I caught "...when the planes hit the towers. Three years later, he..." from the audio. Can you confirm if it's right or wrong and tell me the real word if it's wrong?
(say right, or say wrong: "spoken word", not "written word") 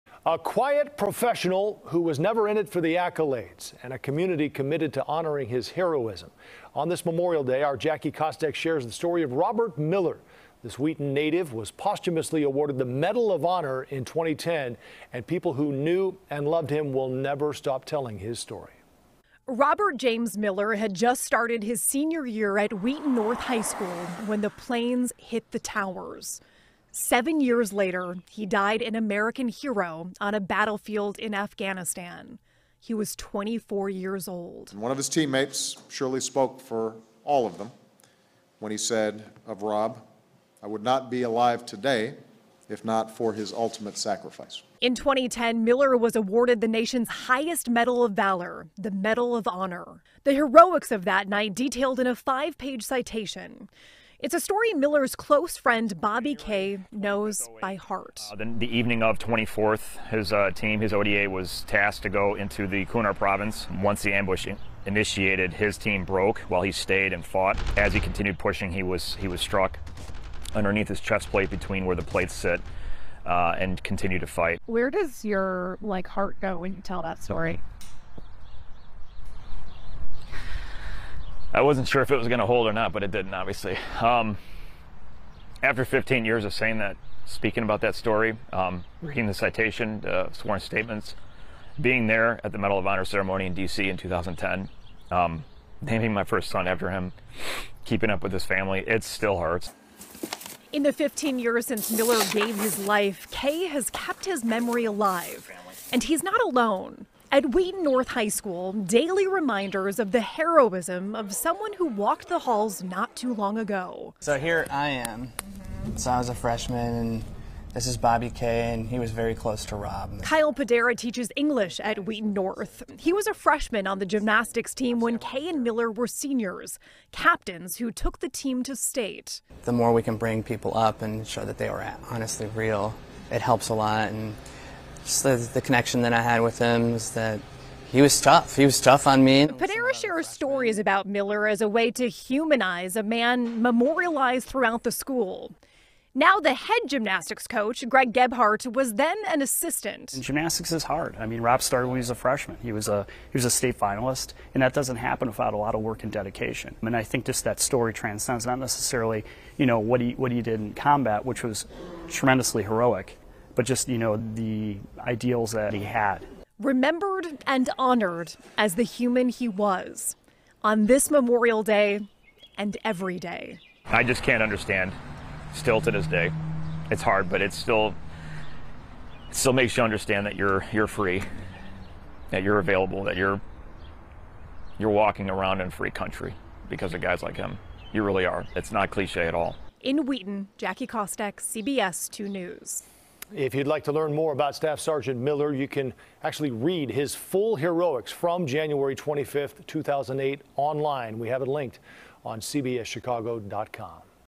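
wrong: "Seven", not "Three".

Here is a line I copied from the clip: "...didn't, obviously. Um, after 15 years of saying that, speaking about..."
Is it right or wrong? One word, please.
right.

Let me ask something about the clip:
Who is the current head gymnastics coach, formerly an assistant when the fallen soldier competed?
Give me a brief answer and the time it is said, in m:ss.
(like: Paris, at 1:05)
Greg Gebhardt, at 2:27.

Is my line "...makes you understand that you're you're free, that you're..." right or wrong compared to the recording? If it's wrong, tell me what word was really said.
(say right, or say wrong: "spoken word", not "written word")
right.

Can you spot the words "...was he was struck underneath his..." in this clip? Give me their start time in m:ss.
1:08.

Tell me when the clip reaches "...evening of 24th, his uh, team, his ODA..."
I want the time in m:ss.
0:58.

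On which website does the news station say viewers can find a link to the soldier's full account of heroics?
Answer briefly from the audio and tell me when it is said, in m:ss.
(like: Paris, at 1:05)
cbschicago.com, at 3:22.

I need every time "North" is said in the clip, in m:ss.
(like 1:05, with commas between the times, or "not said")
0:23, 1:47, 2:02.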